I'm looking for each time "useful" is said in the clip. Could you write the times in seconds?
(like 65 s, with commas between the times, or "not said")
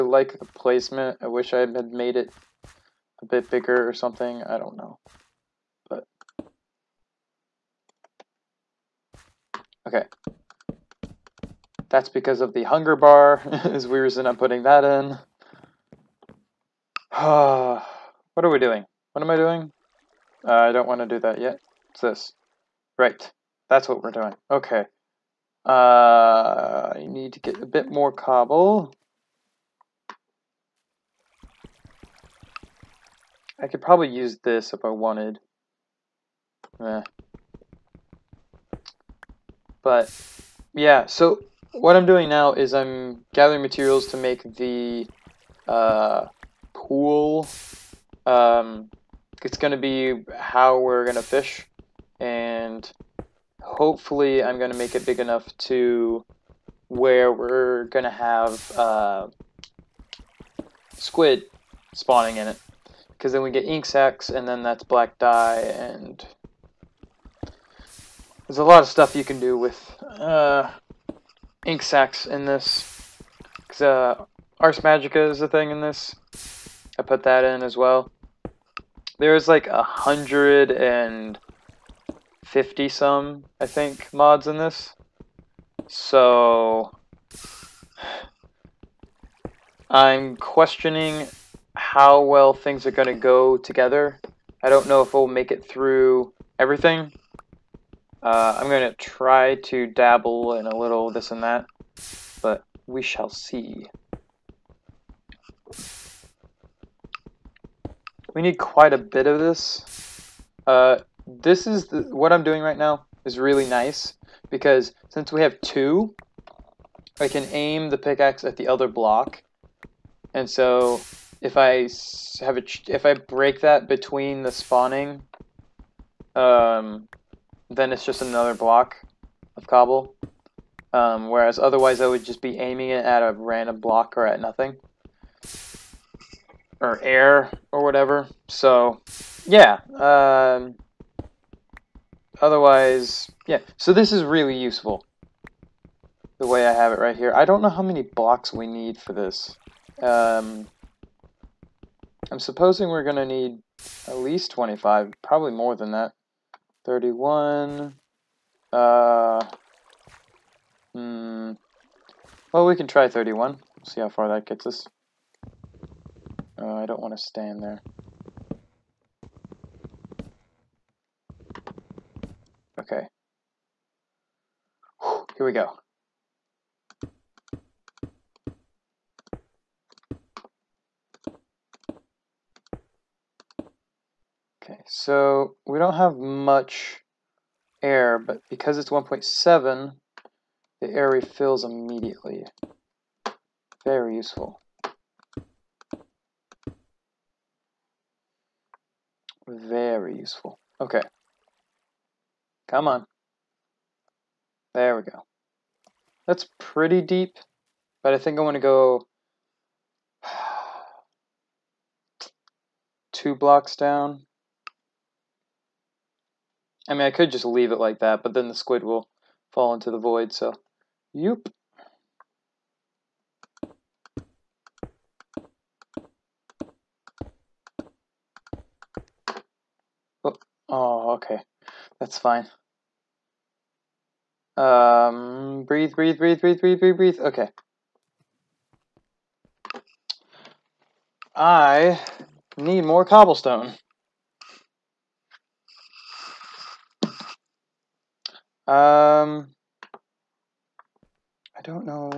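144 s, 194 s, 200 s.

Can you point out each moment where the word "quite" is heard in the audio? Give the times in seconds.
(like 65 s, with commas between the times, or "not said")
108 s.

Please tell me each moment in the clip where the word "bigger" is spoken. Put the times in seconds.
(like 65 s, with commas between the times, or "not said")
3 s.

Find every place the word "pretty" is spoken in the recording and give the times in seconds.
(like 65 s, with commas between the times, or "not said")
206 s.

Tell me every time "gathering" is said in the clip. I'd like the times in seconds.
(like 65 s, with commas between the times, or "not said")
43 s.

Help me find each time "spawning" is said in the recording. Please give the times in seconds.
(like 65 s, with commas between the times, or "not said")
61 s, 124 s.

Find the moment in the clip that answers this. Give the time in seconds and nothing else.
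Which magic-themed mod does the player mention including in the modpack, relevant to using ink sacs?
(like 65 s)
74 s.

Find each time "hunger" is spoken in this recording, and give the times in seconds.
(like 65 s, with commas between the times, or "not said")
12 s.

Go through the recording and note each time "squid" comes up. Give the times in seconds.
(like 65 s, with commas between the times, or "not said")
60 s, 218 s.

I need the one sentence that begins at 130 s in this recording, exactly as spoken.
Um, whereas otherwise I would just be aiming it at a random block or at nothing or air or whatever.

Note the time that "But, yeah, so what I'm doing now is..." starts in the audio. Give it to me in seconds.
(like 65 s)
39 s.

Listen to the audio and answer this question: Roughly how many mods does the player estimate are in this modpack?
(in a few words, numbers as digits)
150.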